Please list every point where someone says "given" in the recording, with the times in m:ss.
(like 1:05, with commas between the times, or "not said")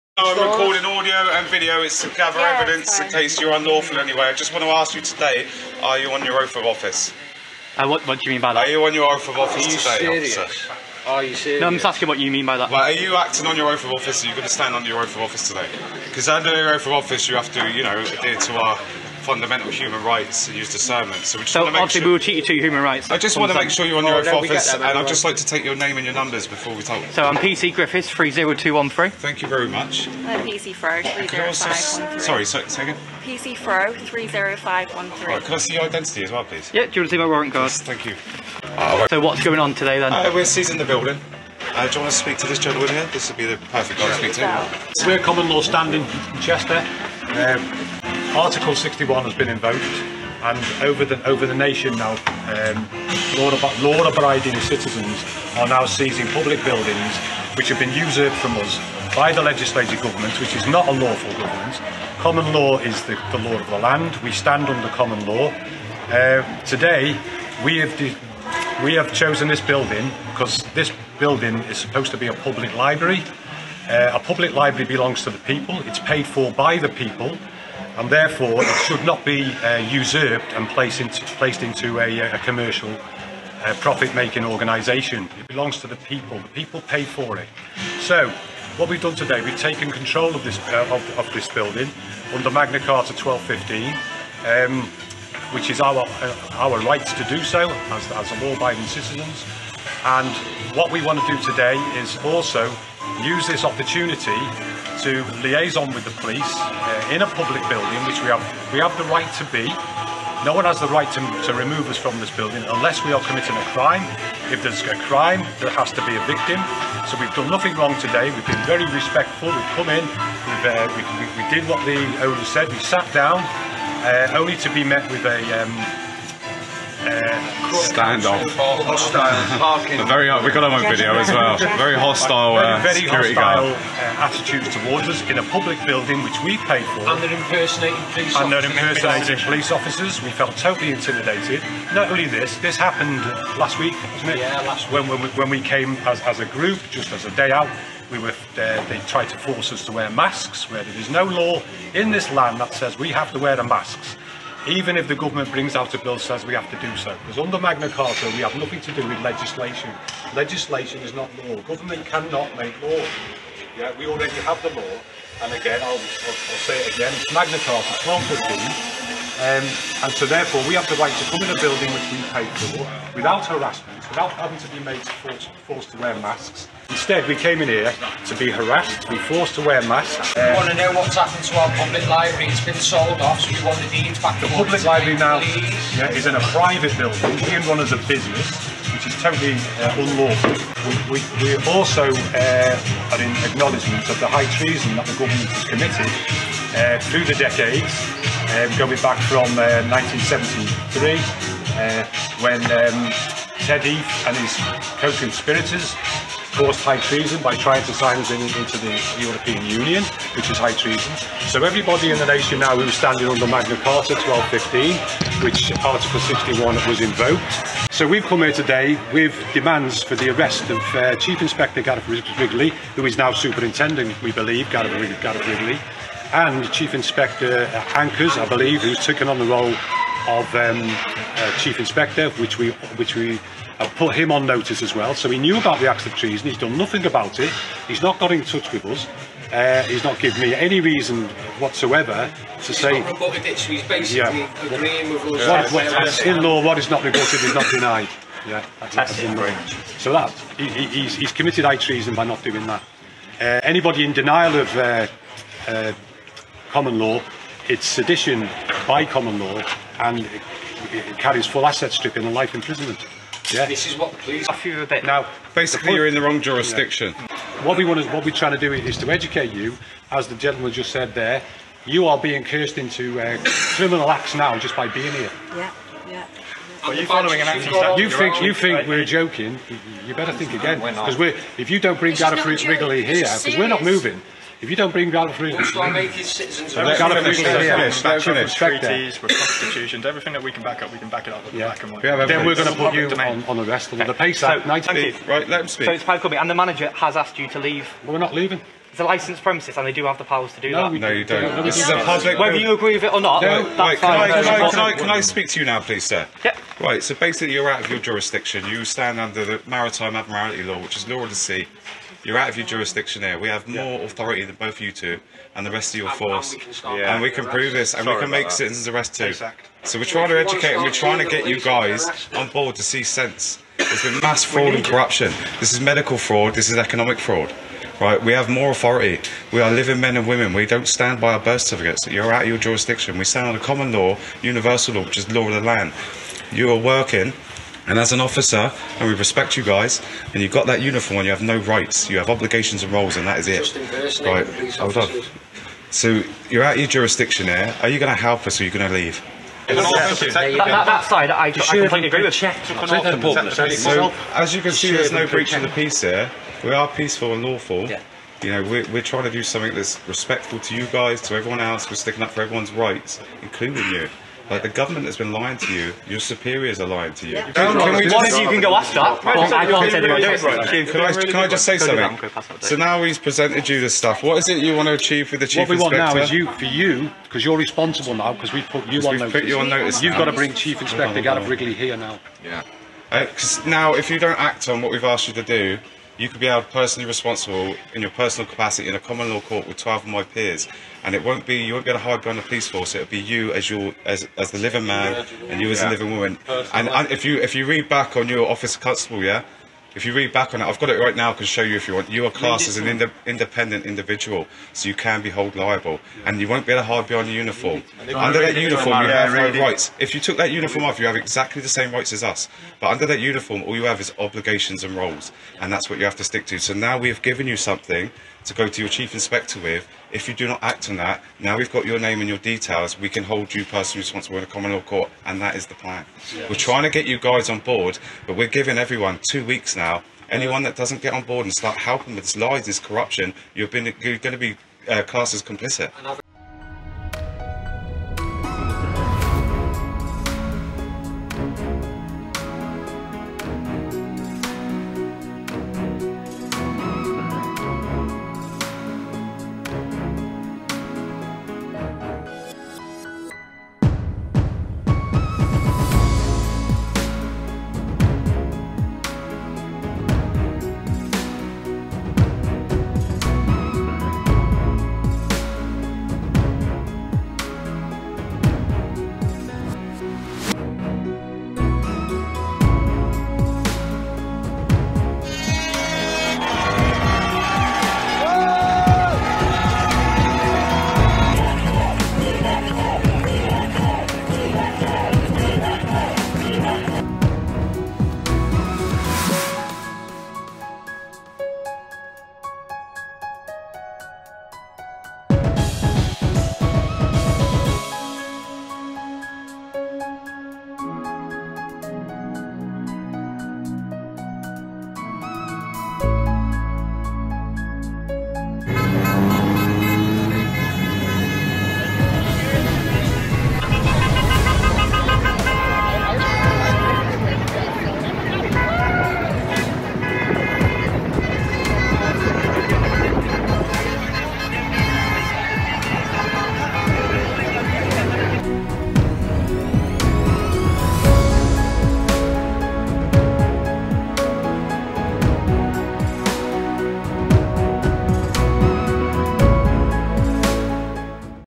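4:00, 6:57.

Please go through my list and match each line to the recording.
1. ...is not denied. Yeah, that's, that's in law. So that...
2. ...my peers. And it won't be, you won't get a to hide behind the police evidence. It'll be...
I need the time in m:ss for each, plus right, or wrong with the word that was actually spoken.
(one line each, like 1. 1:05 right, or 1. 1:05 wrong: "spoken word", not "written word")
1. 4:07 right
2. 6:30 wrong: "force", not "evidence".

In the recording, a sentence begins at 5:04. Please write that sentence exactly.
can I speak to you now, please, sir?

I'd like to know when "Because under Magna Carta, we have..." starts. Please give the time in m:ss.
2:37.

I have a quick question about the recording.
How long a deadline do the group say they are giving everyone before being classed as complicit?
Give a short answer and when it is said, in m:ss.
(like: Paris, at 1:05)
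2 weeks, at 7:09.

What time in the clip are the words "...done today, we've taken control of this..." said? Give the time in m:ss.
1:29.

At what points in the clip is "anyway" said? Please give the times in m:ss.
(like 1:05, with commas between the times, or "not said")
0:03.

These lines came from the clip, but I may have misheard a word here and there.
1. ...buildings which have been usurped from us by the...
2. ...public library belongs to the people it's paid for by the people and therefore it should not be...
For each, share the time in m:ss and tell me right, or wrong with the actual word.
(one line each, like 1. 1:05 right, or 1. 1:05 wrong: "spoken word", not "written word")
1. 0:56 right
2. 1:14 right.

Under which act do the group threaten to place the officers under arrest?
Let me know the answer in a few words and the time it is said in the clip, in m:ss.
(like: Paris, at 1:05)
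PACE Act, at 4:54.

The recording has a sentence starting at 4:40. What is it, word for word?
You better think again, because we're, we're if you don't bring Gareth Wrigley here, because we're not moving.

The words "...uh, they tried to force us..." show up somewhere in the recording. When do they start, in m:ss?
2:28.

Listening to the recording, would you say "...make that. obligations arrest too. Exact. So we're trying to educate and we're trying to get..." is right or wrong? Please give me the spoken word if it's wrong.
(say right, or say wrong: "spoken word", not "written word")
wrong: "citizens", not "obligations".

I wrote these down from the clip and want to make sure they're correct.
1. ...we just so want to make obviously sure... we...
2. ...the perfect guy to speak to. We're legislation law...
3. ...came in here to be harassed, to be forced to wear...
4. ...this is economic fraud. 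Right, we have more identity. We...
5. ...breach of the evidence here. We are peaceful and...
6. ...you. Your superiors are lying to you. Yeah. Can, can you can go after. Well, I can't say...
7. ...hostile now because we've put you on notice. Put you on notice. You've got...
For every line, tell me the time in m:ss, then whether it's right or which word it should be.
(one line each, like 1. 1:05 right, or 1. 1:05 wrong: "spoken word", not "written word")
1. 0:21 right
2. 0:43 wrong: "common", not "legislation"
3. 2:57 right
4. 5:26 wrong: "authority", not "identity"
5. 5:55 wrong: "peace", not "evidence"
6. 6:05 right
7. 6:17 wrong: "responsible", not "hostile".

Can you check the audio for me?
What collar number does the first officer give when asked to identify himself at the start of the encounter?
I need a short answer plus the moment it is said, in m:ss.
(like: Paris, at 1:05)
30213, at 0:28.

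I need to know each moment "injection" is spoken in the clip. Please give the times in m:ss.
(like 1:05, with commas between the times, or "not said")
not said.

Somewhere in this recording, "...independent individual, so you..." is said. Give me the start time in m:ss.
6:43.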